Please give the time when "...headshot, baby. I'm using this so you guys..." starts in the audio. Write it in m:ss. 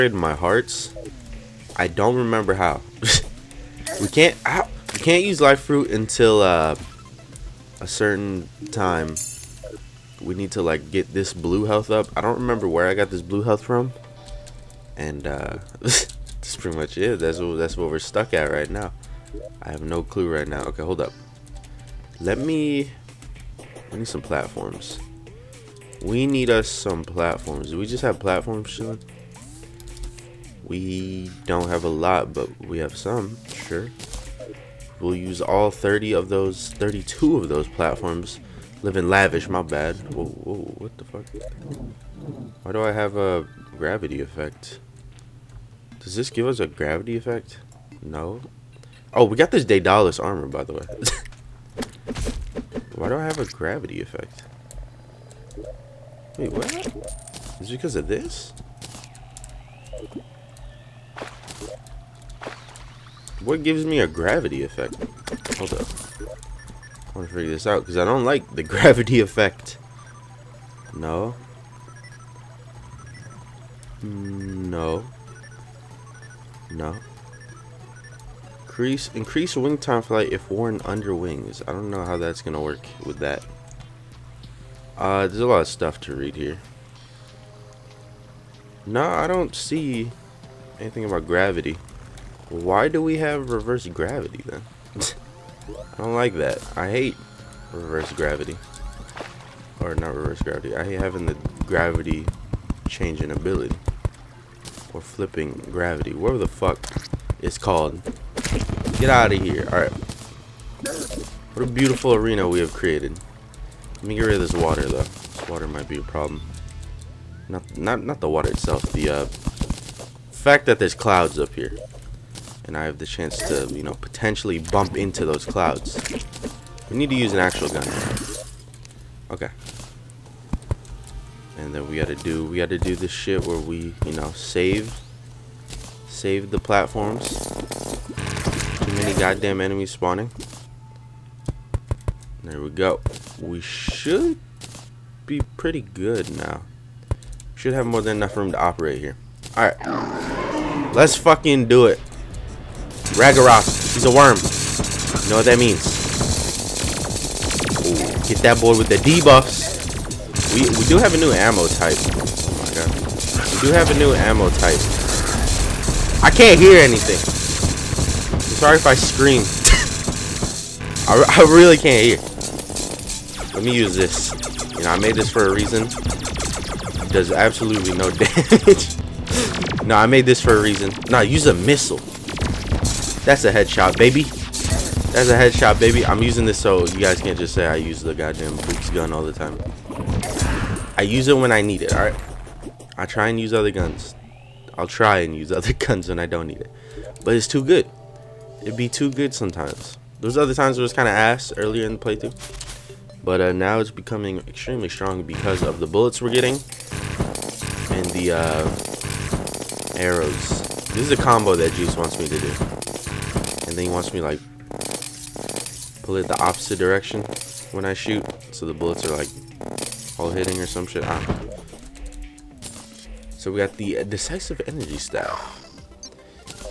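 3:05.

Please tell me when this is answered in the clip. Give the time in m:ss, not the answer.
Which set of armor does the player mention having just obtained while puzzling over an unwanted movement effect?
0:49.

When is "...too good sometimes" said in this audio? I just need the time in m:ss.
3:18.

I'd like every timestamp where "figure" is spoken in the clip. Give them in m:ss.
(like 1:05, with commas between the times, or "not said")
1:07.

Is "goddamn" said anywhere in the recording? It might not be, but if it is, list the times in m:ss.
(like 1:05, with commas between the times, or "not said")
2:19, 3:08.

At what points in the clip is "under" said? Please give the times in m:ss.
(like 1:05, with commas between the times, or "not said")
1:20.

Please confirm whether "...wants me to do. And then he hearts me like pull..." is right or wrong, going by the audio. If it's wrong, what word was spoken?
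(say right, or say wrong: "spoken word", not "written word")
wrong: "wants", not "hearts".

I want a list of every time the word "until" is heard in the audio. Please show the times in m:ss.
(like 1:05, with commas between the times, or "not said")
0:05.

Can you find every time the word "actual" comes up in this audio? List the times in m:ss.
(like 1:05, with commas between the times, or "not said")
2:07.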